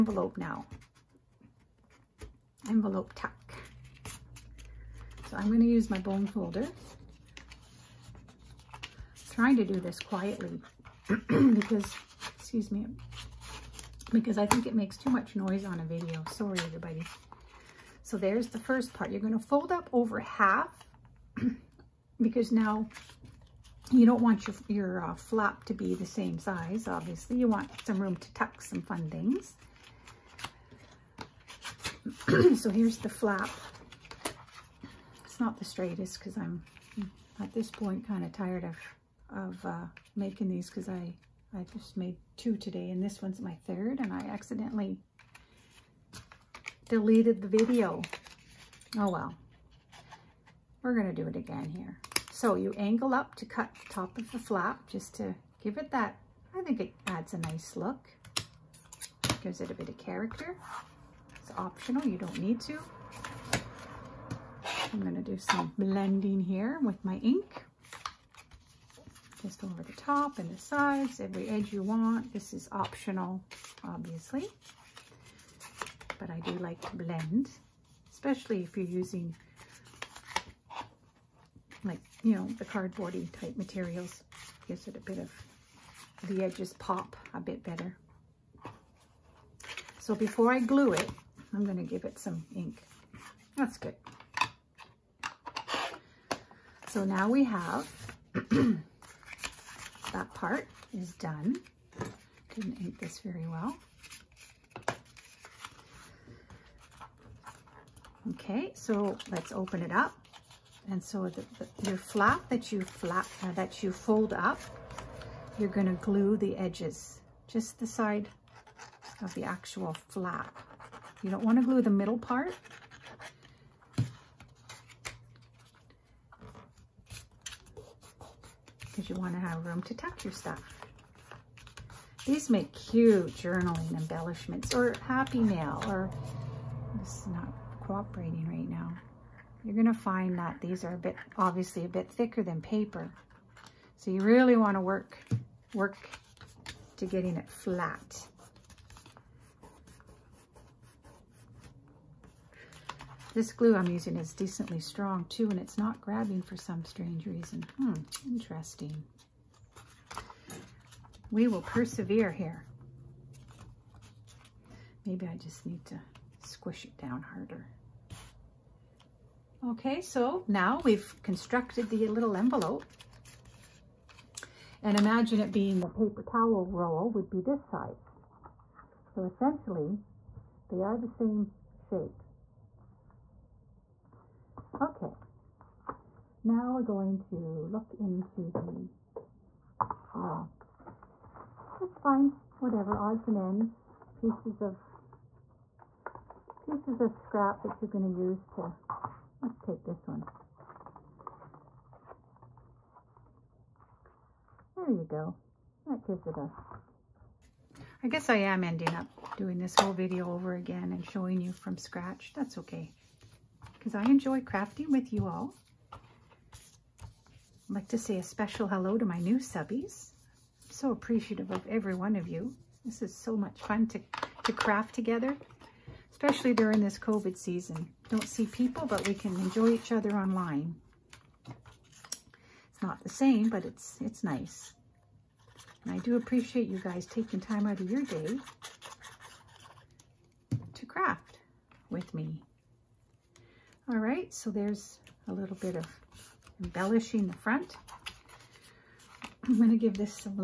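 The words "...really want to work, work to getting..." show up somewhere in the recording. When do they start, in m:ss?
2:24.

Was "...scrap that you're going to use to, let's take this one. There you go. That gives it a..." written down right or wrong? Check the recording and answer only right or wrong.
right.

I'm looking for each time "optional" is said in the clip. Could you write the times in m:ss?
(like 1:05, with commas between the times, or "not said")
1:01, 1:12.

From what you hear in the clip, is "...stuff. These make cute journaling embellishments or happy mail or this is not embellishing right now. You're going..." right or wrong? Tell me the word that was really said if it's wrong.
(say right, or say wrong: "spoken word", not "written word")
wrong: "cooperating", not "embellishing".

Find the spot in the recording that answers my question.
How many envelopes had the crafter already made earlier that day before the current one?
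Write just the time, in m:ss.
0:42.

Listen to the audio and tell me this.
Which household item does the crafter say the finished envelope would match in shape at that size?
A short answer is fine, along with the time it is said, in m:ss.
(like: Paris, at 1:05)
Paper towel roll, at 2:55.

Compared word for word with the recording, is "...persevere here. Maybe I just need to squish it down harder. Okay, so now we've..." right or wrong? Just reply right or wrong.
right.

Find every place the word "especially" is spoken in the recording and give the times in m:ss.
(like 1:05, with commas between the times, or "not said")
1:18, 3:46.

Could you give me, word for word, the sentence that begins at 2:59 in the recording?
So essentially, they are the same shape.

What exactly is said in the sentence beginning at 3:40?
I'm so appreciative of every one of you.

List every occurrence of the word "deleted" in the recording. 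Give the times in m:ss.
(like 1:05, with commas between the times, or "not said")
0:46.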